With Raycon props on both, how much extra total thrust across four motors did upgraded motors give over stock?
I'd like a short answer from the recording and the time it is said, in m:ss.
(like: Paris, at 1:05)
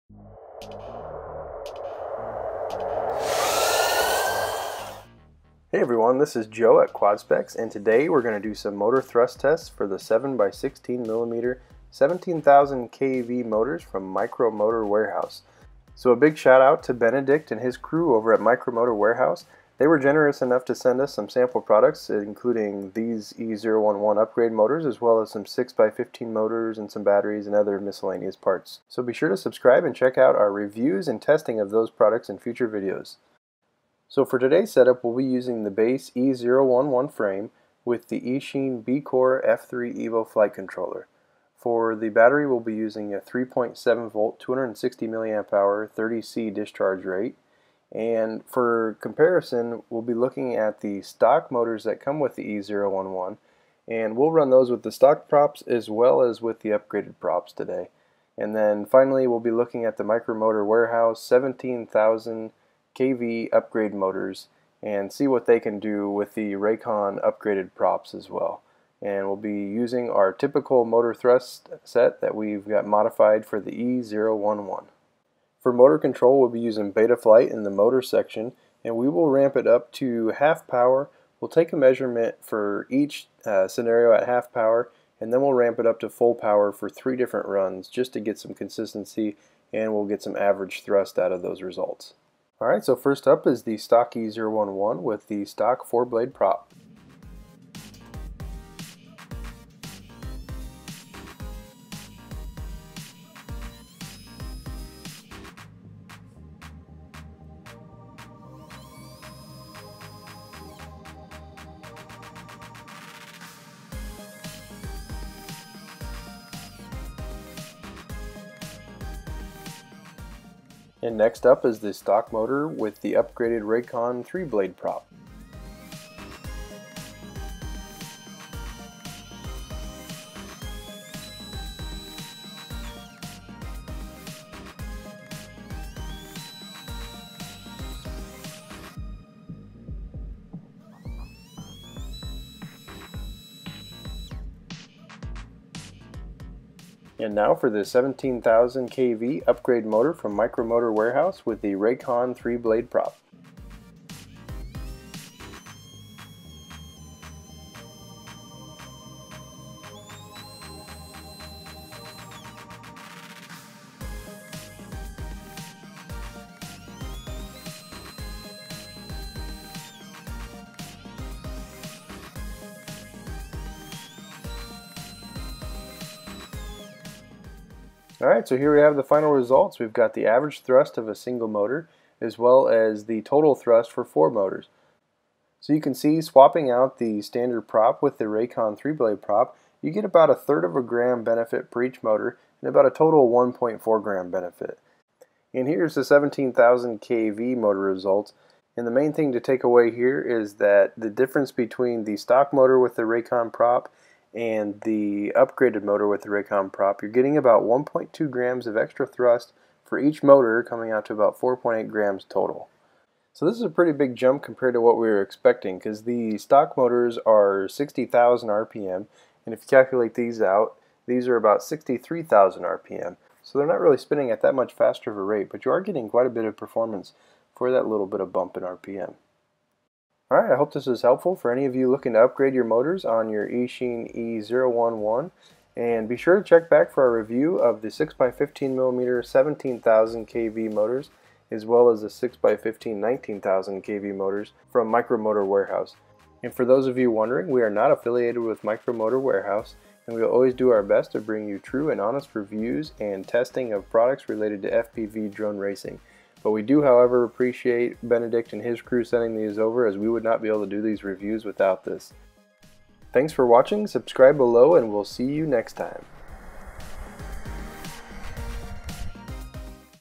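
4.8 grams, at 3:31.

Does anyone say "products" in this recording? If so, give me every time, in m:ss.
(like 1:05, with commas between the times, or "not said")
0:21, 0:31, 4:13.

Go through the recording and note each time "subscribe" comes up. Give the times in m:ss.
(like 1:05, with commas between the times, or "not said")
0:29, 4:23.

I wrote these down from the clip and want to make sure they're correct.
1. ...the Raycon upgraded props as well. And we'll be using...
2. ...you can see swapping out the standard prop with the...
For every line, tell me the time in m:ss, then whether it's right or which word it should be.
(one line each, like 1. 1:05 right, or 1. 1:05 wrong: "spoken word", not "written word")
1. 1:06 right
2. 3:05 right.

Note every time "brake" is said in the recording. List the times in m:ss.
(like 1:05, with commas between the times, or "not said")
not said.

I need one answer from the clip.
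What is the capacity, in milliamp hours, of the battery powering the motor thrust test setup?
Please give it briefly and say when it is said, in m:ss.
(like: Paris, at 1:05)
260 milliamp hour, at 0:44.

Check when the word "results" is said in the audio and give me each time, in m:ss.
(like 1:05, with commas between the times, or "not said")
1:31, 2:59, 3:17.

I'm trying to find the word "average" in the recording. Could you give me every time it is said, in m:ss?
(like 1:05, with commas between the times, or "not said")
1:30, 3:00.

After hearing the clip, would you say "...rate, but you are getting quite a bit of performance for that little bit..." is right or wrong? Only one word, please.
right.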